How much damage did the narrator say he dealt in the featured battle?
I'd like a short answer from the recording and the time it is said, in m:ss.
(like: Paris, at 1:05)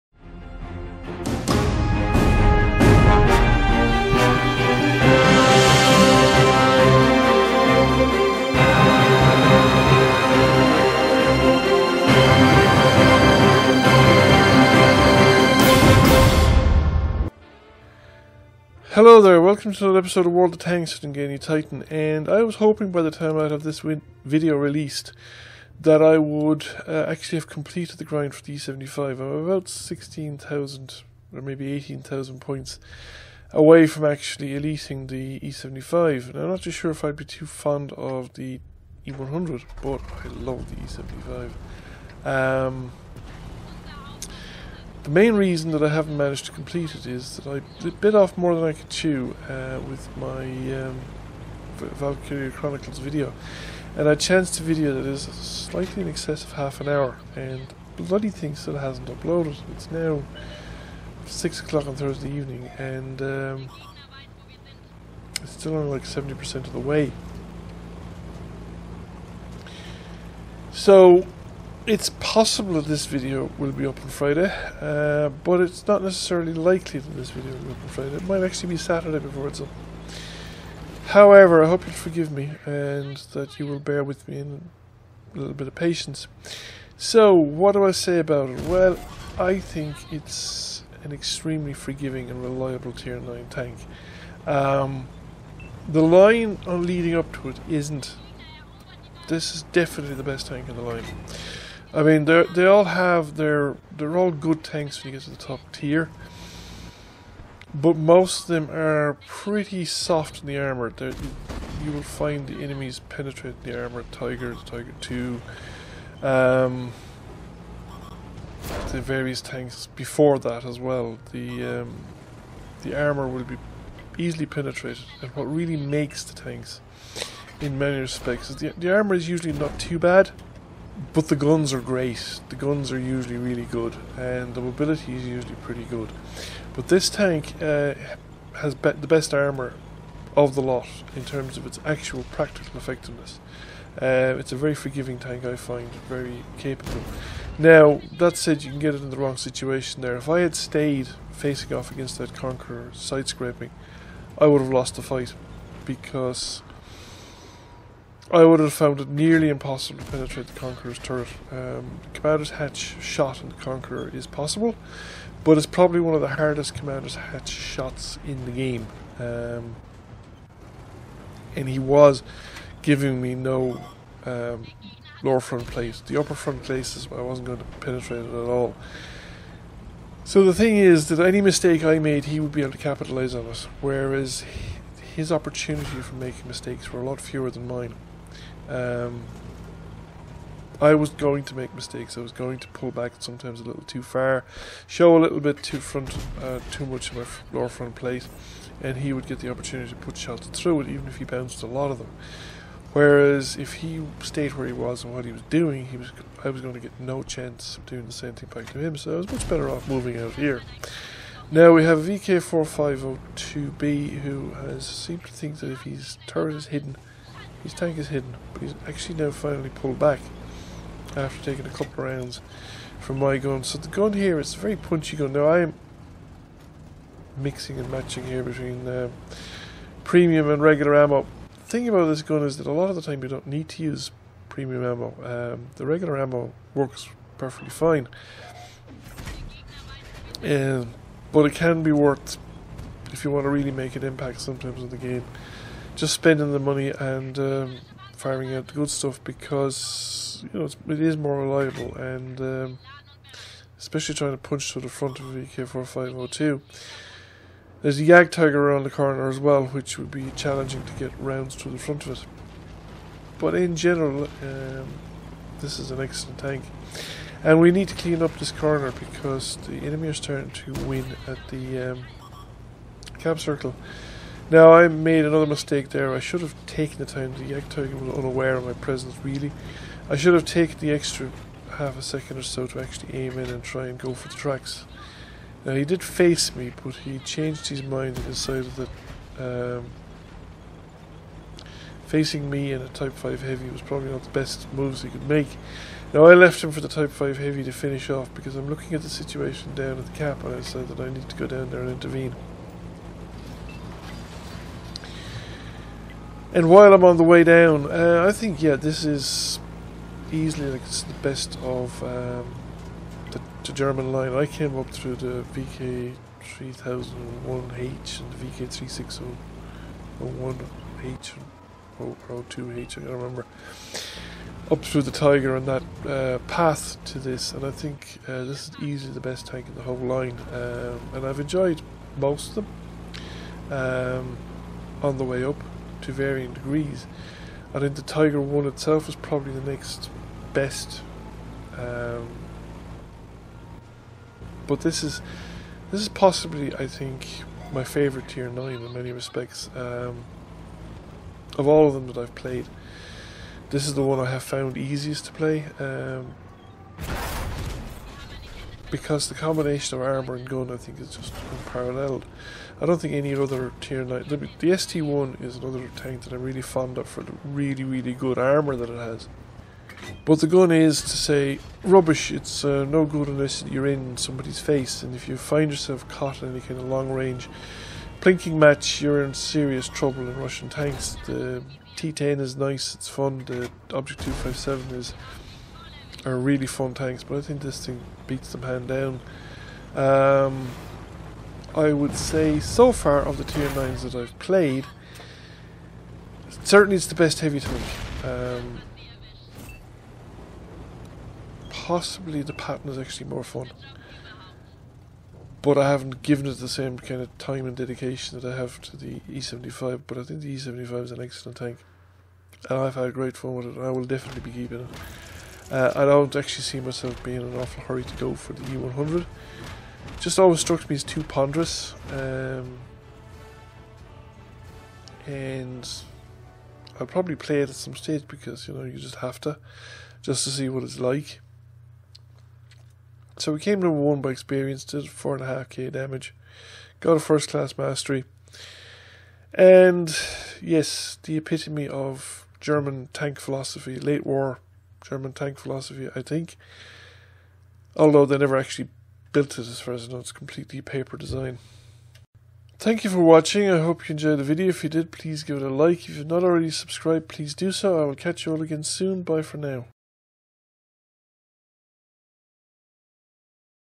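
4.5k, at 7:15.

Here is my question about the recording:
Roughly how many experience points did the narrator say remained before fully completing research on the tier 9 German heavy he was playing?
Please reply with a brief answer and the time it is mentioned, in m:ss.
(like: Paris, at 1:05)
18,000, at 0:31.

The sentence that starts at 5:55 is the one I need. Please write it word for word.
Um, because the combination of armor and gun I think is just unparalleled.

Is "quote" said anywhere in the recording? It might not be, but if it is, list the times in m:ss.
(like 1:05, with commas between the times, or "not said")
not said.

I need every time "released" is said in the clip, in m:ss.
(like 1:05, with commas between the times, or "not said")
0:24.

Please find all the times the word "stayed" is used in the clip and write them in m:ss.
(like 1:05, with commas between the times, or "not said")
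2:30, 3:24.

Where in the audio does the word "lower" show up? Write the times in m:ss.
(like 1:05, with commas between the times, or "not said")
2:55, 3:17.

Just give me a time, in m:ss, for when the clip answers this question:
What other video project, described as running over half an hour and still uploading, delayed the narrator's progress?
0:51.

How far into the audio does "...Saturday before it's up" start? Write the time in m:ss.
1:18.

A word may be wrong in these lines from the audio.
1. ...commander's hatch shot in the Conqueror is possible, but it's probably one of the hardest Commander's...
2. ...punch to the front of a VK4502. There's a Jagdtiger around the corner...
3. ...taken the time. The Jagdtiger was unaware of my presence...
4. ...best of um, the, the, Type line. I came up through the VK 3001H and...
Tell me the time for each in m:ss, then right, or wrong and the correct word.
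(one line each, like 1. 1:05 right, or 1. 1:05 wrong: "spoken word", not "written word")
1. 2:42 right
2. 4:14 right
3. 4:36 right
4. 5:11 wrong: "German", not "Type".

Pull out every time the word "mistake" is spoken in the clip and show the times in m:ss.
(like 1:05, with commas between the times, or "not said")
3:01, 3:06, 3:11, 4:35.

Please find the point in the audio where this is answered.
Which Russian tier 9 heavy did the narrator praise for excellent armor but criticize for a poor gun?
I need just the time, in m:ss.
6:04.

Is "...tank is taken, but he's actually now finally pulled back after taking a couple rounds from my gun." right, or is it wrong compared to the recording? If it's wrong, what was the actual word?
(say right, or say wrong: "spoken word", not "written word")
wrong: "hidden", not "taken".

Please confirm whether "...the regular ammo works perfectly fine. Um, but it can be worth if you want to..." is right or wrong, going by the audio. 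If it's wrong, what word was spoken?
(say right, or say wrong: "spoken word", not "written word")
right.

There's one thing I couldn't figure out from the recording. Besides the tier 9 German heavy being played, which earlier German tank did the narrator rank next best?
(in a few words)
Tiger one.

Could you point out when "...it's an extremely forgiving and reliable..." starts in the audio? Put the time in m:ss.
1:30.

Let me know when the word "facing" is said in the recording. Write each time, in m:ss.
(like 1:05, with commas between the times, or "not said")
2:31, 4:52.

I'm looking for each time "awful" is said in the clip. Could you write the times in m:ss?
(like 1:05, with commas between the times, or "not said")
6:57.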